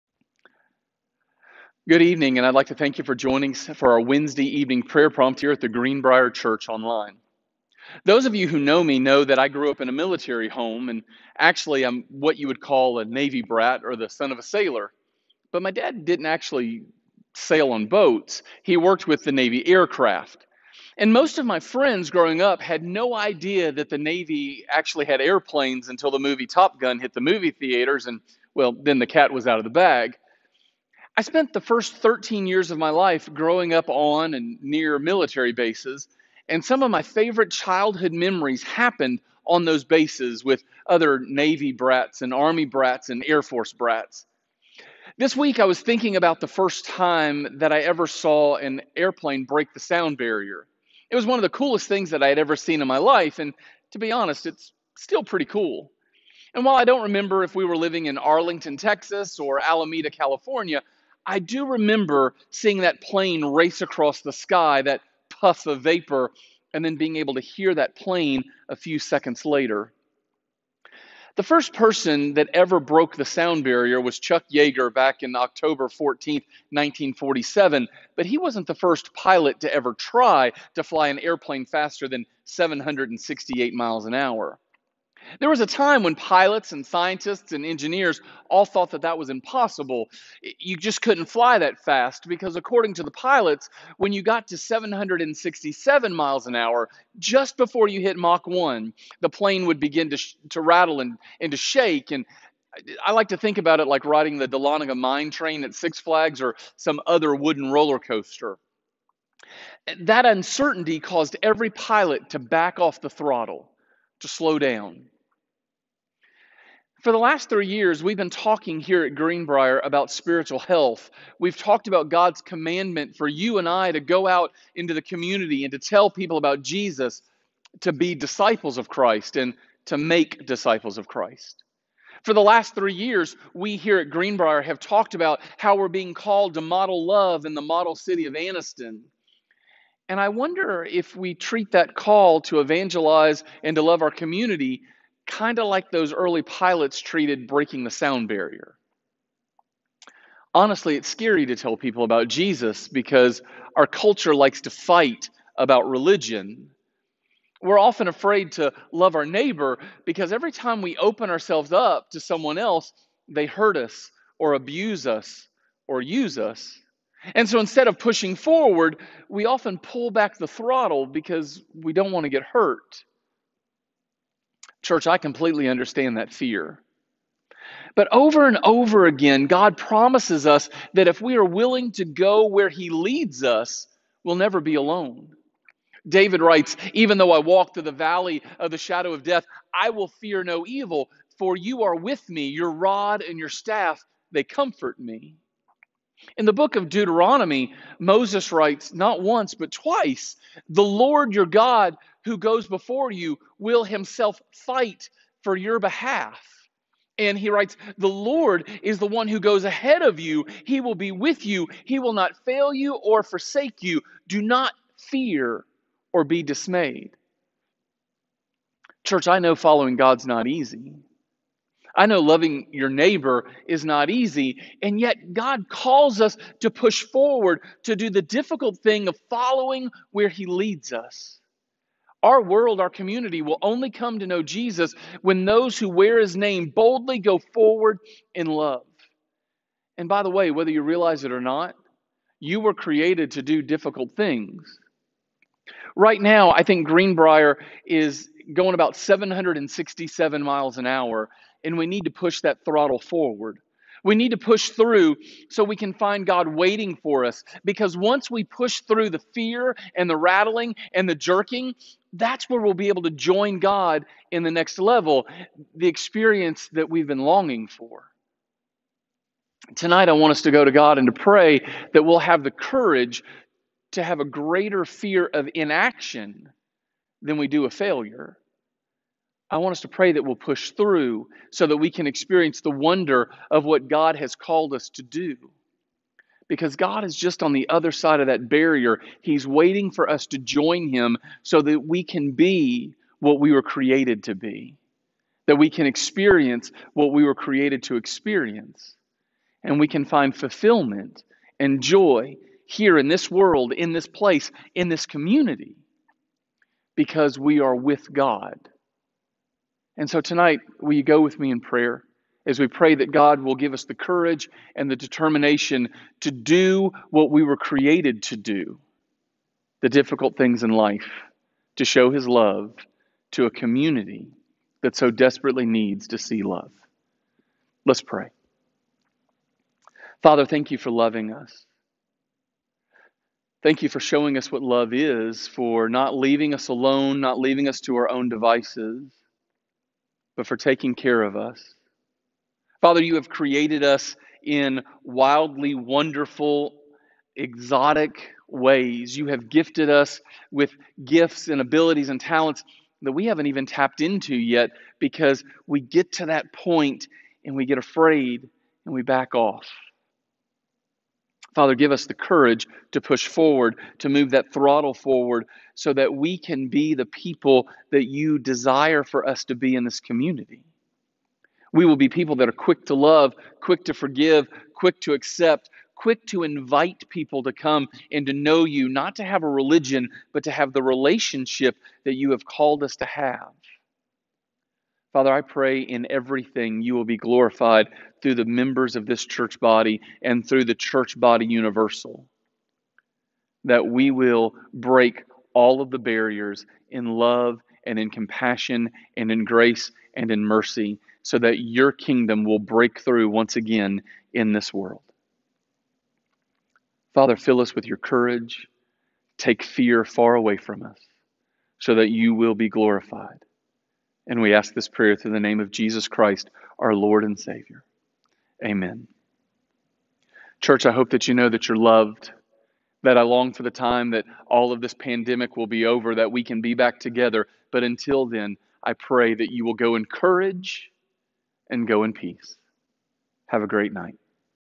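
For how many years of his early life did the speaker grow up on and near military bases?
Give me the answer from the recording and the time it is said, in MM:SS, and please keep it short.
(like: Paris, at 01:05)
13, at 00:31.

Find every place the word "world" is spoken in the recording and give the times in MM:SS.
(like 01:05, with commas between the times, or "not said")
03:52, 05:03, 06:44.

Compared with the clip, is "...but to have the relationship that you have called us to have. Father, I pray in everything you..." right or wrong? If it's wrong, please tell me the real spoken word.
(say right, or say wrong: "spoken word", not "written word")
right.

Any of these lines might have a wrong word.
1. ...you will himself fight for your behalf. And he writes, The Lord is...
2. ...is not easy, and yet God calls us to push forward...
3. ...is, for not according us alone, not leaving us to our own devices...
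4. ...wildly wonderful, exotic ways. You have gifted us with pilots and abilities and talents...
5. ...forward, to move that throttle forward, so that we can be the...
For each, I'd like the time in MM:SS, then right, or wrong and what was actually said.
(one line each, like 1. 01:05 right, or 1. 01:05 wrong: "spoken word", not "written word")
1. 03:23 right
2. 03:43 right
3. 05:34 wrong: "leaving", not "according"
4. 05:45 wrong: "gifts", not "pilots"
5. 06:03 right.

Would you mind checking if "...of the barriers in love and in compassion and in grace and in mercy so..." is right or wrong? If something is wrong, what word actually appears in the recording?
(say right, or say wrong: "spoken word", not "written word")
right.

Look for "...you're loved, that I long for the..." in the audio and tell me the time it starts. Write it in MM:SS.
07:01.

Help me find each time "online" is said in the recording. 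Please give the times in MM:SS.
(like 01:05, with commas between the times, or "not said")
00:06.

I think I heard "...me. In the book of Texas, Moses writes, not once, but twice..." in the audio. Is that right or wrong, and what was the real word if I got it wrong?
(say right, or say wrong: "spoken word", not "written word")
wrong: "Deuteronomy", not "Texas".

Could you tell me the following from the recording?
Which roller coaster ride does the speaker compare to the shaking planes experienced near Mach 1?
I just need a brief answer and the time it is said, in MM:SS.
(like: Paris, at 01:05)
Dahlonega mine train, at 01:44.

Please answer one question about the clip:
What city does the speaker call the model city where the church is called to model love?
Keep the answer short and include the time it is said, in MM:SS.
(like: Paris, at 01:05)
Anniston, at 02:18.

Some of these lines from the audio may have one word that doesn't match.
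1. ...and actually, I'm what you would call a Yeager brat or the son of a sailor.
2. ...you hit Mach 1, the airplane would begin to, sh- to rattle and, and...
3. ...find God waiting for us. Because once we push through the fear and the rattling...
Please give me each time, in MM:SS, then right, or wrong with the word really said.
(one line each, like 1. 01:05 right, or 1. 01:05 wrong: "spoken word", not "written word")
1. 00:10 wrong: "Navy", not "Yeager"
2. 01:37 wrong: "plane", not "airplane"
3. 04:15 right.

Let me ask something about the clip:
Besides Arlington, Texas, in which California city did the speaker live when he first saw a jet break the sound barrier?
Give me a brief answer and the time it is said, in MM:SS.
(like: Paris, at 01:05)
Alameda, at 00:59.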